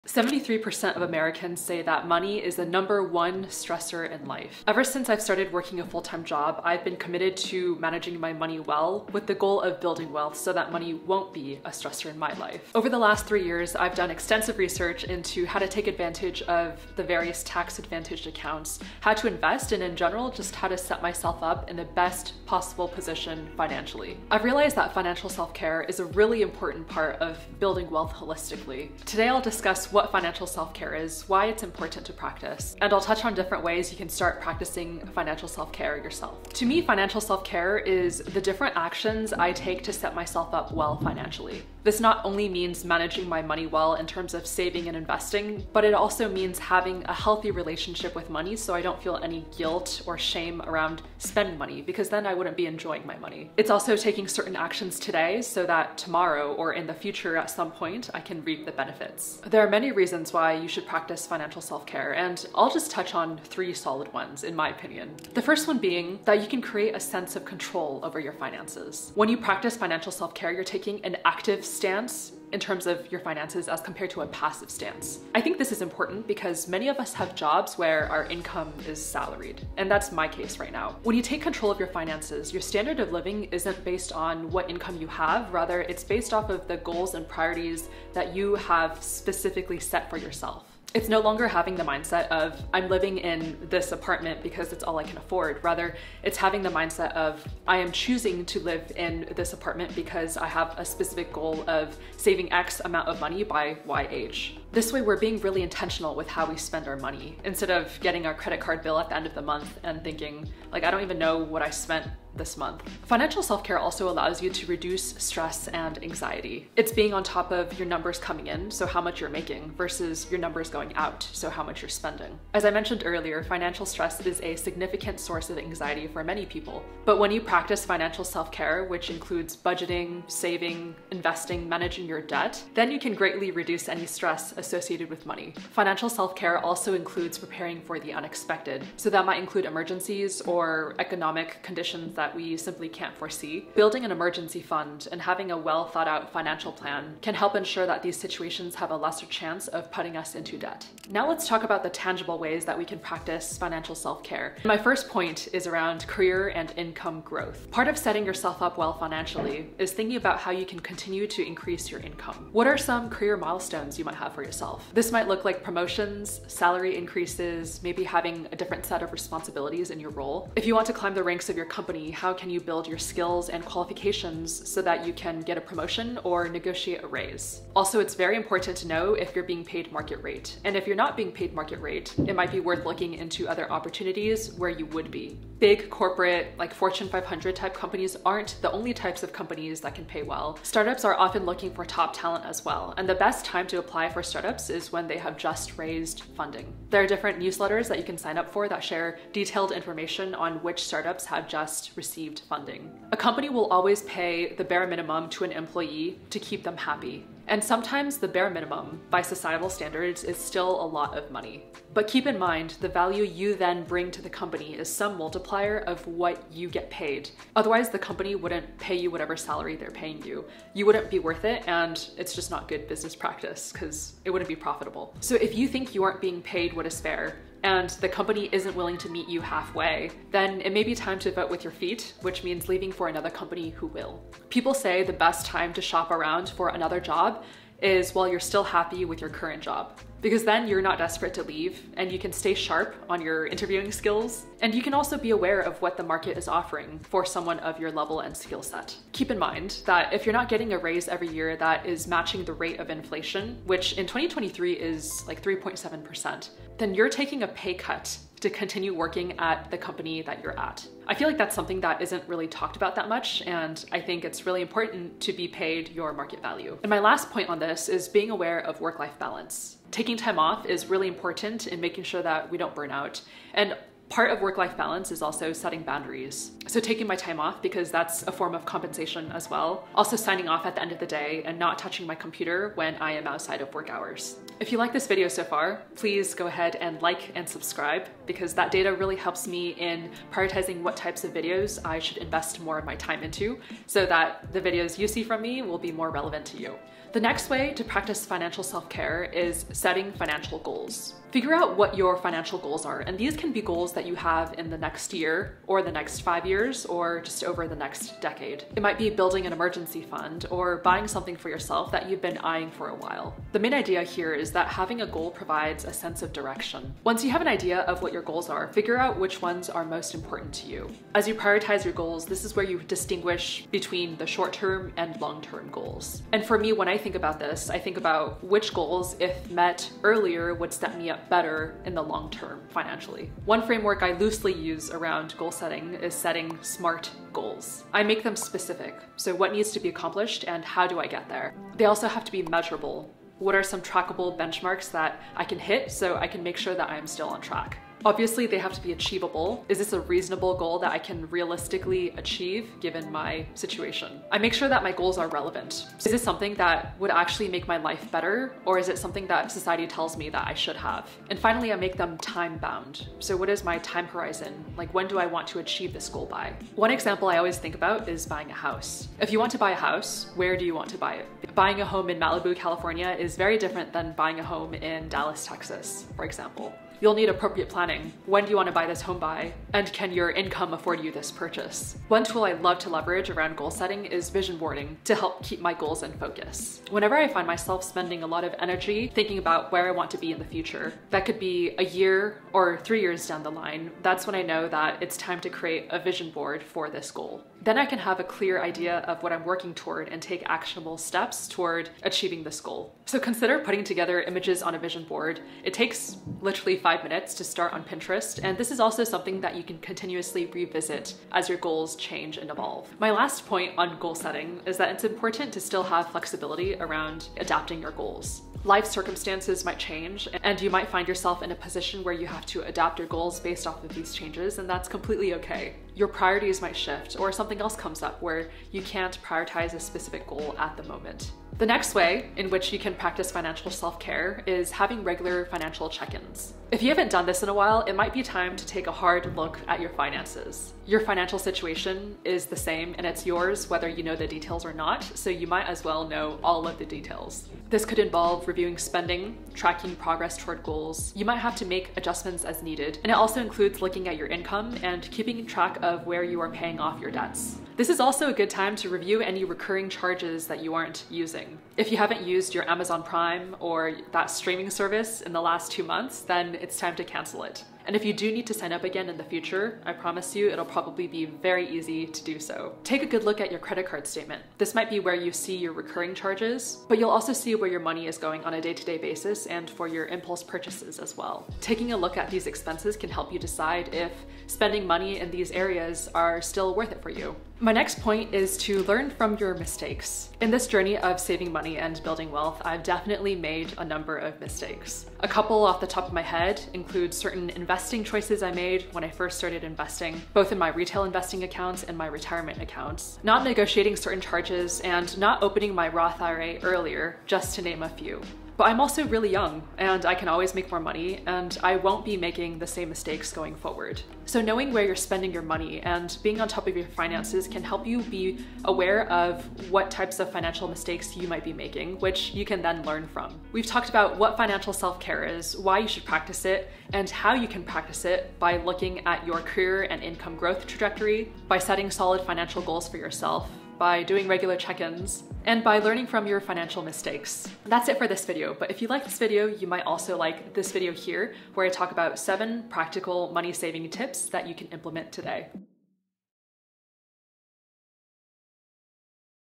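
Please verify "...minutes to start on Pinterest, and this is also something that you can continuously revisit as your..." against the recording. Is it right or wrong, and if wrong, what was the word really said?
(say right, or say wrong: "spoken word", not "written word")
right.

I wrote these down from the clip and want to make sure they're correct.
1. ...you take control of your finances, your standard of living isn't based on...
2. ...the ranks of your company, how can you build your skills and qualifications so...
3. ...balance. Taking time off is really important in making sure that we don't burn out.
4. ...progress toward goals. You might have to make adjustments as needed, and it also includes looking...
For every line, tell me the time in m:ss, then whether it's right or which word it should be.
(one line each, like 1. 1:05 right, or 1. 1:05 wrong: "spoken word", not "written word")
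1. 1:21 right
2. 2:51 right
3. 4:29 right
4. 7:29 right.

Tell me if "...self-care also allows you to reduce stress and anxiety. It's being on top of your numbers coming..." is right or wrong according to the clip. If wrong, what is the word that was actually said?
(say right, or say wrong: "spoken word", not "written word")
right.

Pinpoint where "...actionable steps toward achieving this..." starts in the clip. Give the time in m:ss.
6:40.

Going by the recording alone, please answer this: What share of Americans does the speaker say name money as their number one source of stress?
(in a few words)
73%.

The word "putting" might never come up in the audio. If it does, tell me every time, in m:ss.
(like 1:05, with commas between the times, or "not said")
2:29, 6:43.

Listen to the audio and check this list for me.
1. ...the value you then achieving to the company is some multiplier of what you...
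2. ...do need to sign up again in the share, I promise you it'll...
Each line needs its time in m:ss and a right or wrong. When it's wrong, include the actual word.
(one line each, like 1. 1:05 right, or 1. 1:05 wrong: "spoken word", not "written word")
1. 3:32 wrong: "bring", not "achieving"
2. 7:48 wrong: "future", not "share".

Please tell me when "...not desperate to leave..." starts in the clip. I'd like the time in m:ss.
4:00.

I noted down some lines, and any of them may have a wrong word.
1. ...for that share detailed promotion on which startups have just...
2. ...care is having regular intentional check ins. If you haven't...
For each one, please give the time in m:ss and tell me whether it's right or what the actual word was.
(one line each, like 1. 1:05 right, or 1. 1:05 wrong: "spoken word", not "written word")
1. 3:18 wrong: "information", not "promotion"
2. 7:13 wrong: "financial", not "intentional".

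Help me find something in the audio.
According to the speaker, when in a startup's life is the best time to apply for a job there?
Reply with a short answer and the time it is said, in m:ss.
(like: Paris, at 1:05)
Just raised funding, at 3:15.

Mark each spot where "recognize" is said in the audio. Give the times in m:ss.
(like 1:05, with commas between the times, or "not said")
not said.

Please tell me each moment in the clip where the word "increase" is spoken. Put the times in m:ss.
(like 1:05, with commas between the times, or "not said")
2:41, 2:46.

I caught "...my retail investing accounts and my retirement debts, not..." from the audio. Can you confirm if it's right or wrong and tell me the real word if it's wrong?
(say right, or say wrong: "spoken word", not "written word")
wrong: "accounts", not "debts".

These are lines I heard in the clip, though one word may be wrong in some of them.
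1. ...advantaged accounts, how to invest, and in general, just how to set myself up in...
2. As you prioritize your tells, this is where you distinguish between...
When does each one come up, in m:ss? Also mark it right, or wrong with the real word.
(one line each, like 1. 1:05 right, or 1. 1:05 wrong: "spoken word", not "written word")
1. 0:17 right
2. 5:21 wrong: "goals", not "tells".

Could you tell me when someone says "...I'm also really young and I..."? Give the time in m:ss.
8:28.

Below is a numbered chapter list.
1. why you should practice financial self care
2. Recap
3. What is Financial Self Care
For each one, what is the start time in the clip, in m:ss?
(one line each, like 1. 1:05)
1. 1:05
2. 8:42
3. 0:36.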